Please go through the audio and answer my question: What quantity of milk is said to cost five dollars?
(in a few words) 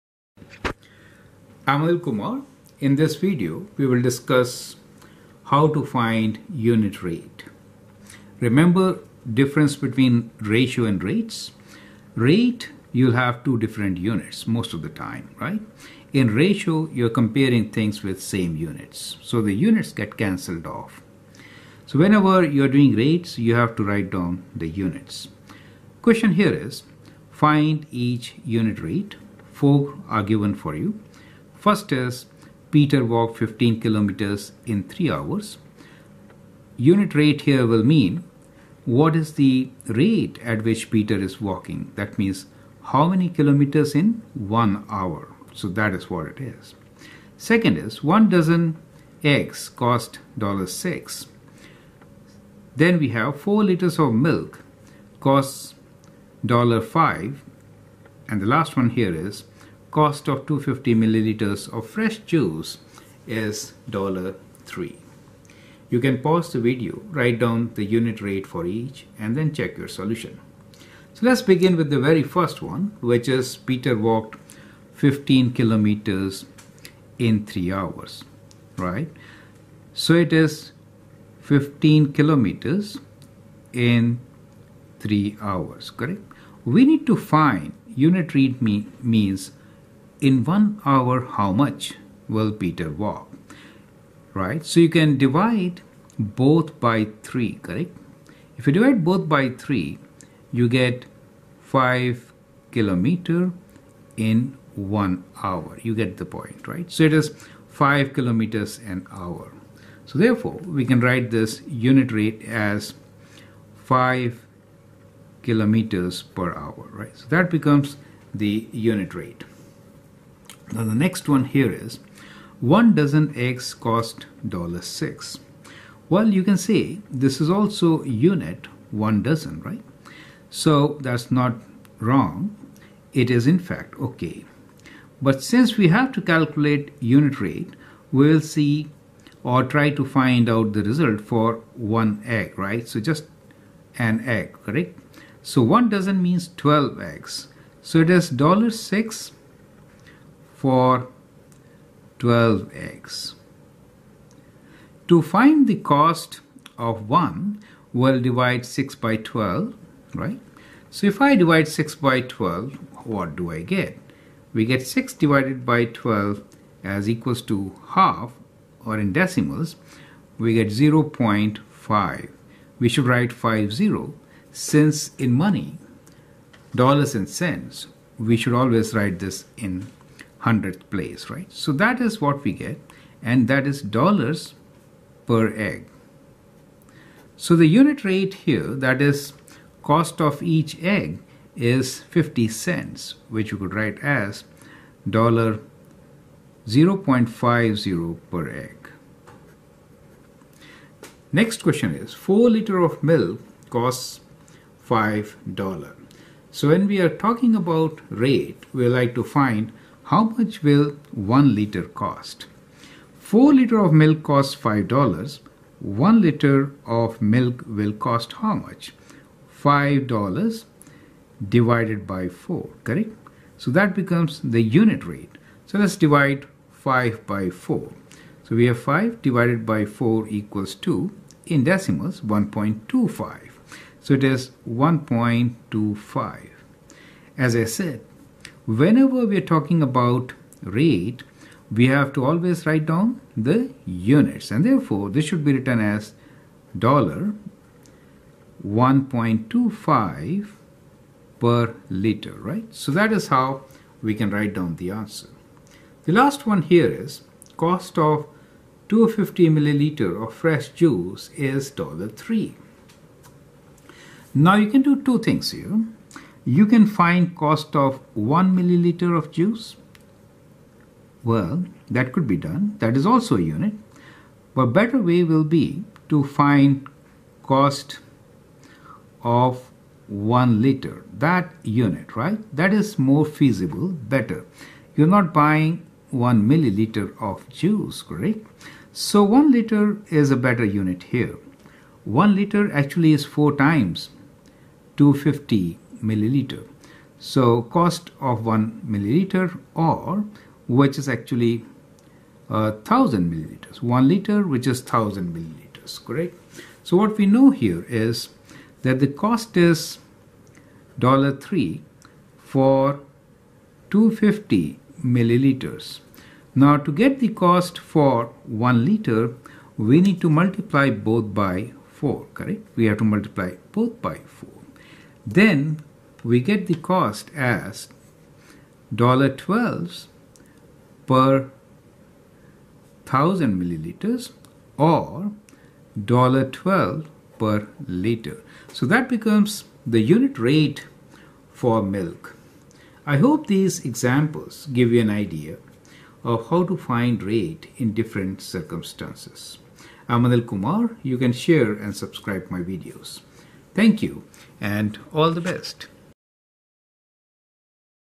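4 liters.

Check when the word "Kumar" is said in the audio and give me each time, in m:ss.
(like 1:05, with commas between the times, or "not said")
0:02, 5:50.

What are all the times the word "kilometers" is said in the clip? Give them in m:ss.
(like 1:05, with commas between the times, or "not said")
0:33, 0:43, 1:15, 1:22, 1:42, 1:48, 1:55.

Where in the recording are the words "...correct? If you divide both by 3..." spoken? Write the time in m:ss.
1:37.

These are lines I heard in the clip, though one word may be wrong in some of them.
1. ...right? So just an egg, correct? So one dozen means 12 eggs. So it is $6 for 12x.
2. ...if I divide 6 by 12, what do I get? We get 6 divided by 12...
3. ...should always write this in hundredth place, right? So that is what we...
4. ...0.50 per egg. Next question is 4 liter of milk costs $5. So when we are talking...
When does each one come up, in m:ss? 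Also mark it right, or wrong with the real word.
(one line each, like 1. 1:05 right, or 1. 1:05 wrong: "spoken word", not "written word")
1. 2:22 right
2. 2:41 right
3. 2:58 right
4. 3:16 right.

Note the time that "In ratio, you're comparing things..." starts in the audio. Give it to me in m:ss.
0:16.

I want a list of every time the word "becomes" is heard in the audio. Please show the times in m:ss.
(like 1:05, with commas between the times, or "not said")
1:57, 3:43, 5:39.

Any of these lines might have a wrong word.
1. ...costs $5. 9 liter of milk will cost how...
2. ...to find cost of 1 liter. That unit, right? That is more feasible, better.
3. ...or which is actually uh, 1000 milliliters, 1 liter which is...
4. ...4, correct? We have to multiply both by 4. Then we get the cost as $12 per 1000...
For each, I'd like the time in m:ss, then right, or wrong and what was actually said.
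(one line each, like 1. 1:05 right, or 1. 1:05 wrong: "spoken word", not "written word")
1. 3:34 wrong: "1", not "9"
2. 4:36 right
3. 4:59 right
4. 5:21 right.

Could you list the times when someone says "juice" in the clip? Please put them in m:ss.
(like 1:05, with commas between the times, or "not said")
1:02, 4:20, 4:29, 4:47.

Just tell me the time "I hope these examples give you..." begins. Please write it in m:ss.
5:43.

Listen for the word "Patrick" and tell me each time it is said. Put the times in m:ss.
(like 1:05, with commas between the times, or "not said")
not said.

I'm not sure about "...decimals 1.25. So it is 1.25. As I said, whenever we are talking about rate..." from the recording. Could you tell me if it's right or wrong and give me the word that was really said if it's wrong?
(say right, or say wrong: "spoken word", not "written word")
right.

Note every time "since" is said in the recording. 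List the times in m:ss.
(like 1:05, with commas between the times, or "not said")
2:15, 2:54.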